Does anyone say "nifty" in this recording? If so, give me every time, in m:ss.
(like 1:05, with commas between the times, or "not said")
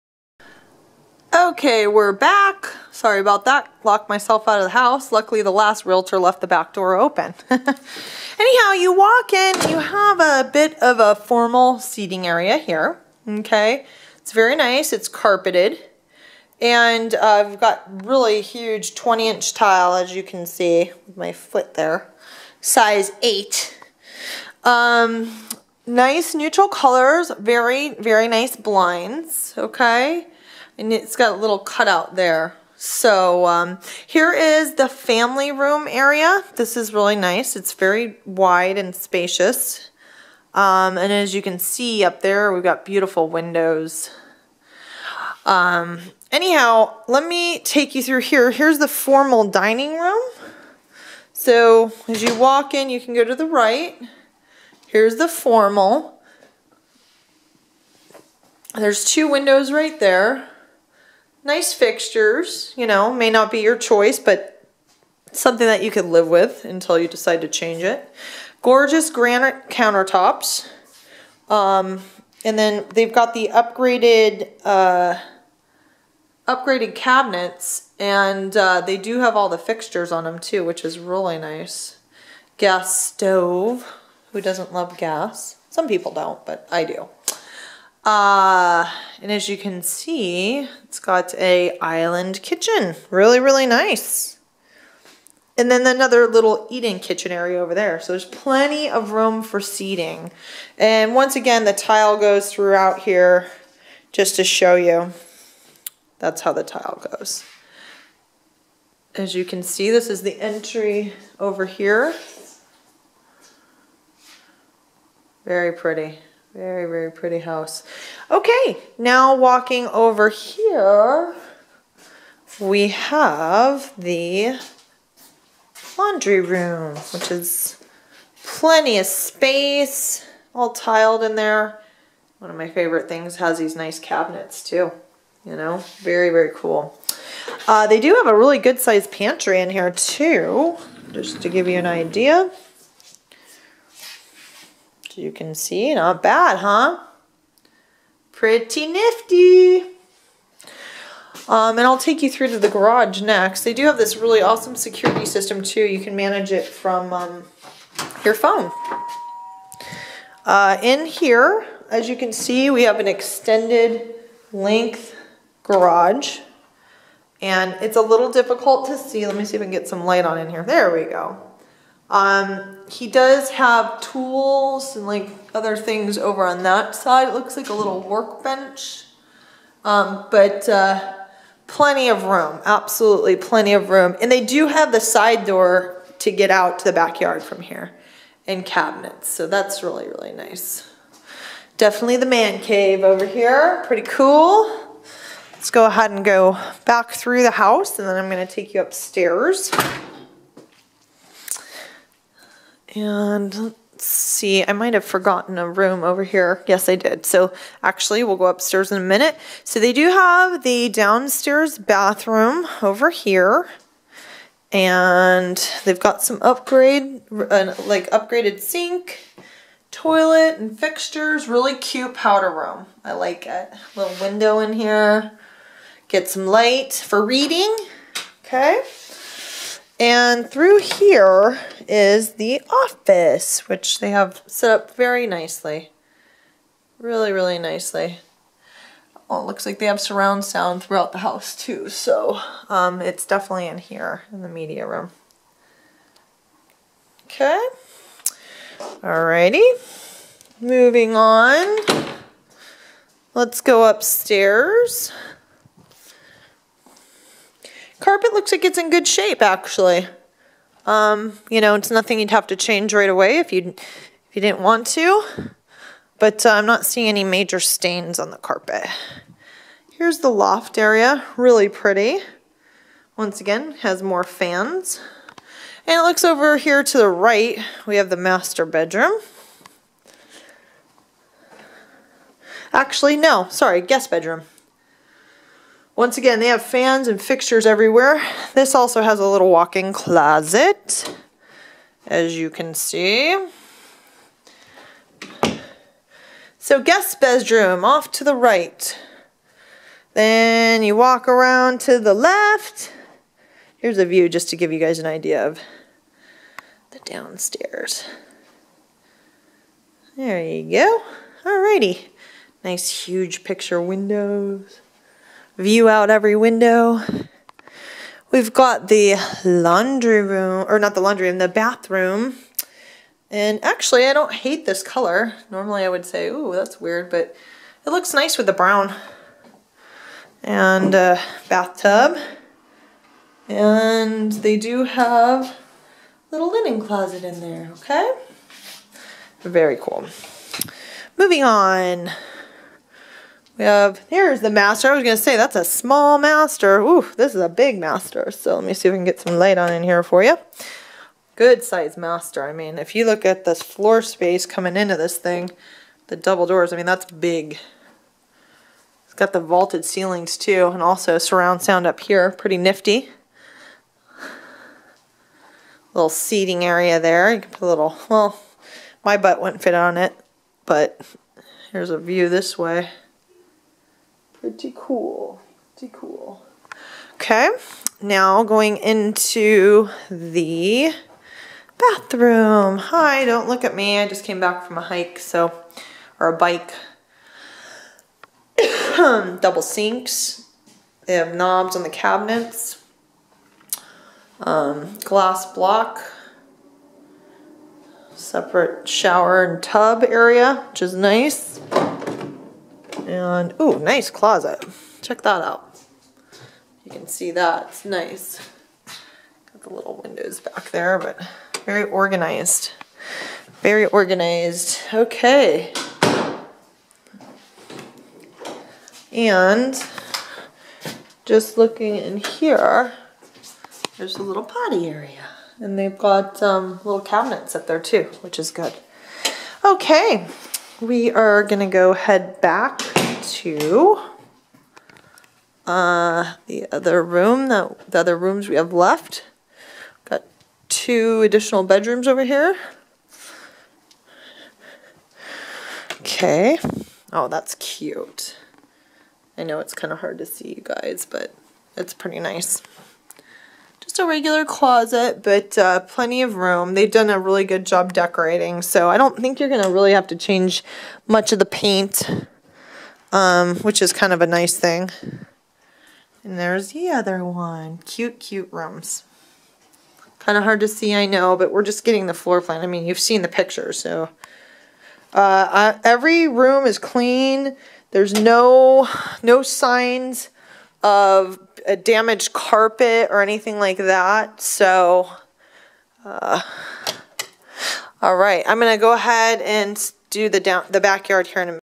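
2:28, 6:02.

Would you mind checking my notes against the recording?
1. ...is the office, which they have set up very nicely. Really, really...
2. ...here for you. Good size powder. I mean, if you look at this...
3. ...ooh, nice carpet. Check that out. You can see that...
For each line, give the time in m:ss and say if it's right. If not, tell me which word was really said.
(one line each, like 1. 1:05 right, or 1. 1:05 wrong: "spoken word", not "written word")
1. 3:51 right
2. 5:49 wrong: "master", not "powder"
3. 6:43 wrong: "closet", not "carpet".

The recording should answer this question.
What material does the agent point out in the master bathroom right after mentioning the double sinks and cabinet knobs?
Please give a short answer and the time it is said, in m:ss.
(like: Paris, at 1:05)
Glass block, at 6:35.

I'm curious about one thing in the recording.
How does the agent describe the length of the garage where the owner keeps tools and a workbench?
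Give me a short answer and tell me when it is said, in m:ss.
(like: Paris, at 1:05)
Extended length, at 2:43.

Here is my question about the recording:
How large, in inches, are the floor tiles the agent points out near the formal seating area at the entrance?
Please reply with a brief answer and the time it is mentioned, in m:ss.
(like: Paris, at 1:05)
20 inch, at 0:18.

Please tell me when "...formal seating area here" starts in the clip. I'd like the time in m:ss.
0:11.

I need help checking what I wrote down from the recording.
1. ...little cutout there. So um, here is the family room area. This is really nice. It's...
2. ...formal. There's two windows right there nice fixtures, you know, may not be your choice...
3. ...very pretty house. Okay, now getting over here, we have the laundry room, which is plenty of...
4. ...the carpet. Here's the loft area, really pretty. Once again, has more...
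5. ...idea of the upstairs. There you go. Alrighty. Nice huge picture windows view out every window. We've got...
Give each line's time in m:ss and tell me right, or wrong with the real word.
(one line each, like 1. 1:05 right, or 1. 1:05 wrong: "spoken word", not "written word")
1. 0:31 right
2. 0:55 right
3. 1:56 wrong: "walking", not "getting"
4. 4:28 right
5. 5:05 wrong: "downstairs", not "upstairs".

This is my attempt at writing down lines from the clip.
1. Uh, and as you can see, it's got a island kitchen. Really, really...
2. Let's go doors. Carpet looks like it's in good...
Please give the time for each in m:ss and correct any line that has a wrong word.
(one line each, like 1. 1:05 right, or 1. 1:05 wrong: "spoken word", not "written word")
1. 1:28 right
2. 4:13 wrong: "upstairs", not "doors".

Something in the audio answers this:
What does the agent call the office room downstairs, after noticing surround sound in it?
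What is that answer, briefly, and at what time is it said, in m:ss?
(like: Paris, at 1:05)
Media room, at 4:04.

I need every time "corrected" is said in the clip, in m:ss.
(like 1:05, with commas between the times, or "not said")
not said.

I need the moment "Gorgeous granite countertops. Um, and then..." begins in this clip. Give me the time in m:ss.
1:08.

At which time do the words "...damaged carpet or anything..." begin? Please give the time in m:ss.
8:01.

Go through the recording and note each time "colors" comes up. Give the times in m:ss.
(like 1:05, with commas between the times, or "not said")
0:26, 5:24.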